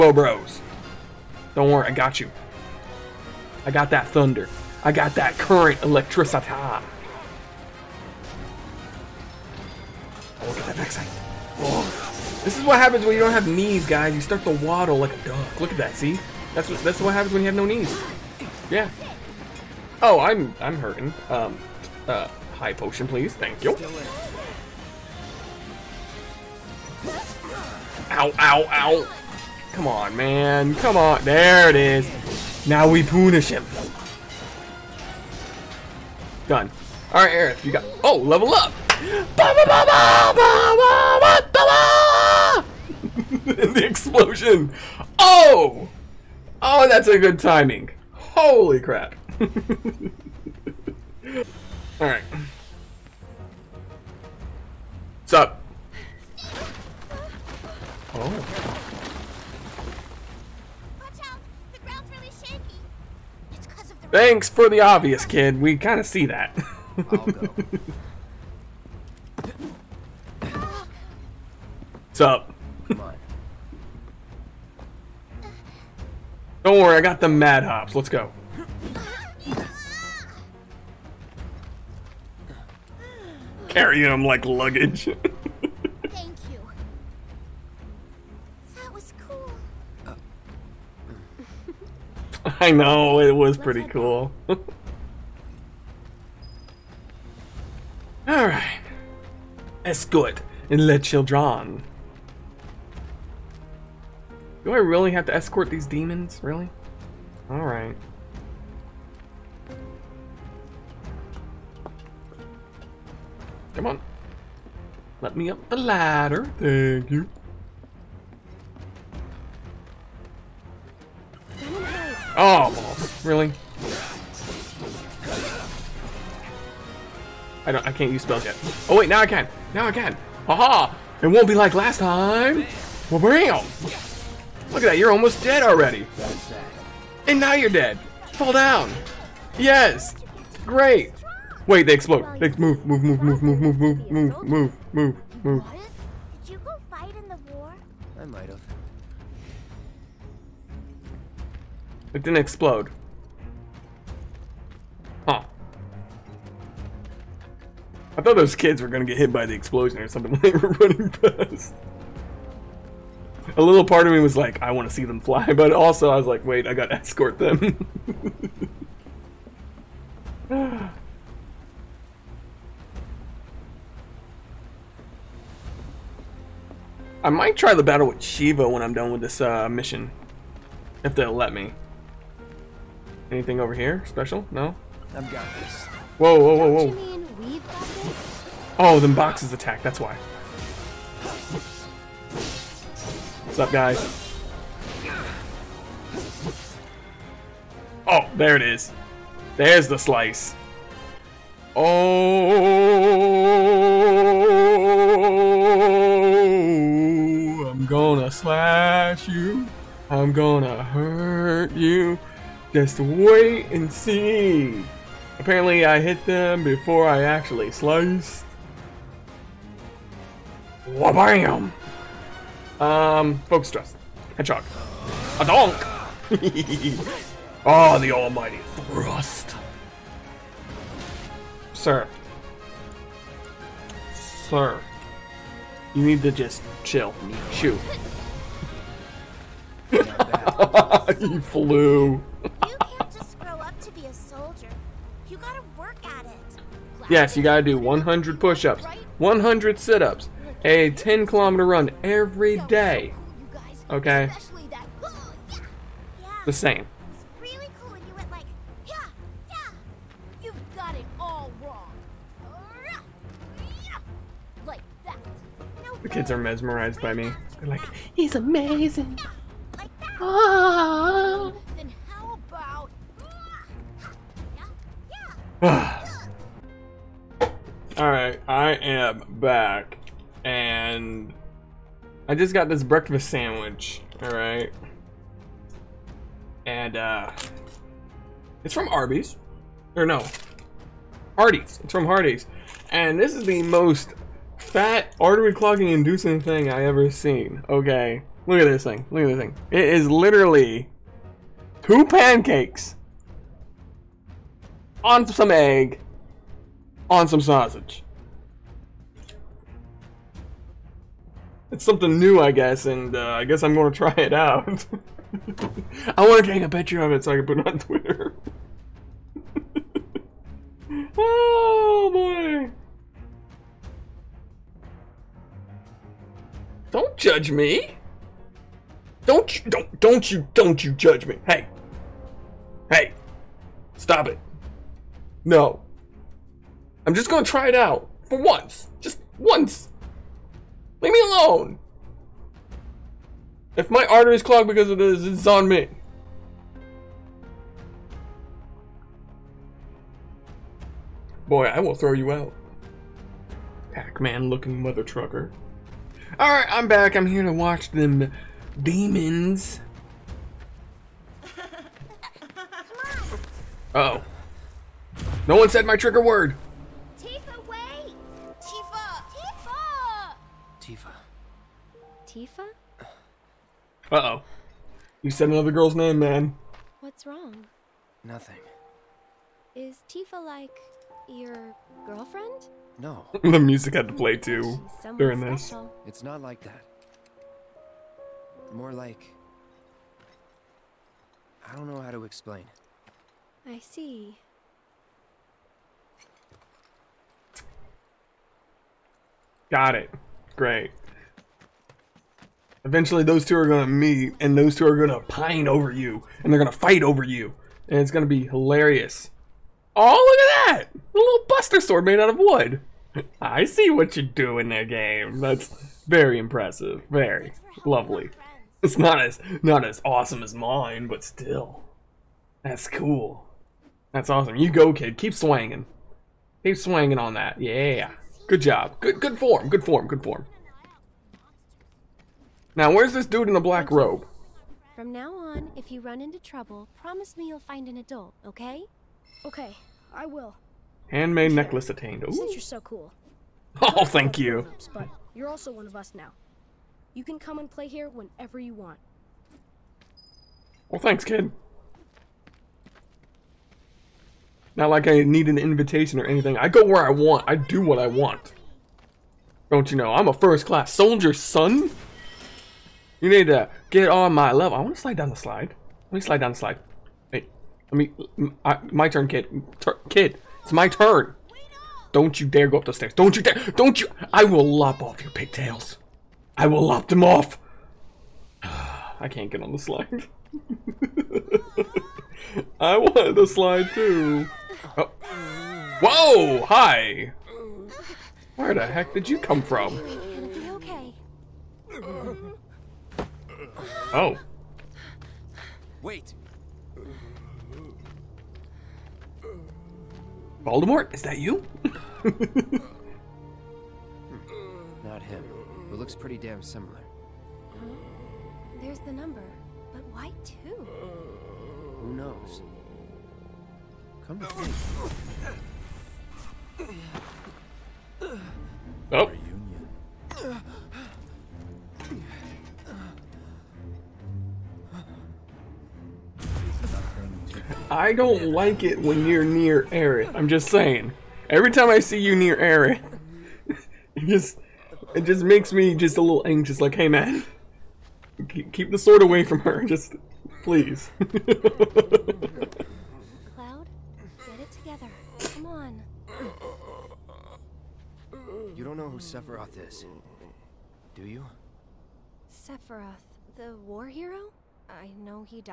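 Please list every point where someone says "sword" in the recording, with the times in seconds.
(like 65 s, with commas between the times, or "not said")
411 s, 538 s.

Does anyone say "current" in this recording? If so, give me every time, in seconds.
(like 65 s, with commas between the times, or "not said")
5 s.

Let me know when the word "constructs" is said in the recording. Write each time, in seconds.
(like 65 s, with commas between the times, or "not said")
not said.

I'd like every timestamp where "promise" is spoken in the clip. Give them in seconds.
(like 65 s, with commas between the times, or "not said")
437 s.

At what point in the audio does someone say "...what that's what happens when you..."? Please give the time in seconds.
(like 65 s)
16 s.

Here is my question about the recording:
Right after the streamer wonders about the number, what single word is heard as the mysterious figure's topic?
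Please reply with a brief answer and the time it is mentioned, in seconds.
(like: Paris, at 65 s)
Reunion, at 519 s.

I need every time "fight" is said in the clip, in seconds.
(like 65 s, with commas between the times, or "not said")
146 s, 406 s.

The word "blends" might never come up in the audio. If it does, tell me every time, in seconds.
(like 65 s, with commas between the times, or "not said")
not said.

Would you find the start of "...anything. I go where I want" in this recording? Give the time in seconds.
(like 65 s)
456 s.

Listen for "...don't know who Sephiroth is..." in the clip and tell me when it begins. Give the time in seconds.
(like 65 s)
548 s.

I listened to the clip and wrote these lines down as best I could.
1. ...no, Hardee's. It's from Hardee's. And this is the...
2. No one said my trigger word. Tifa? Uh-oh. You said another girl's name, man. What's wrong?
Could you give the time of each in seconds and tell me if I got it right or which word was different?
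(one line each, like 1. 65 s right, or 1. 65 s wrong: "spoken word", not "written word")
1. 290 s right
2. 365 s right.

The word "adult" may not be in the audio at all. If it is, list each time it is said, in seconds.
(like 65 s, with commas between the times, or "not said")
437 s.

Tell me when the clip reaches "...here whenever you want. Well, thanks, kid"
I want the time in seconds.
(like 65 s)
447 s.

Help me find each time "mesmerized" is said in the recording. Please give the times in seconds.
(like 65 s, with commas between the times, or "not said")
266 s.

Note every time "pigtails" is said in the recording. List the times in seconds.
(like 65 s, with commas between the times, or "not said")
475 s.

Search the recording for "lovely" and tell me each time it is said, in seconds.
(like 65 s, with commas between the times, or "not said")
417 s.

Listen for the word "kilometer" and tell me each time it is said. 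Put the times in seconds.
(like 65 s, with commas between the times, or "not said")
251 s.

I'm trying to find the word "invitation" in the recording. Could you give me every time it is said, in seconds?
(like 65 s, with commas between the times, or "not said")
455 s.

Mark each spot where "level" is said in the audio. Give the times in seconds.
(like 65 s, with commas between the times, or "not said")
38 s, 464 s.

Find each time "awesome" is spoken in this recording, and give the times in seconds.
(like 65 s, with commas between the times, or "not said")
420 s, 424 s.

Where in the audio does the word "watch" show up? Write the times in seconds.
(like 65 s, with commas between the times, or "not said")
357 s.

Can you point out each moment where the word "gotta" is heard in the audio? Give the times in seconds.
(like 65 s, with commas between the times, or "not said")
166 s, 247 s.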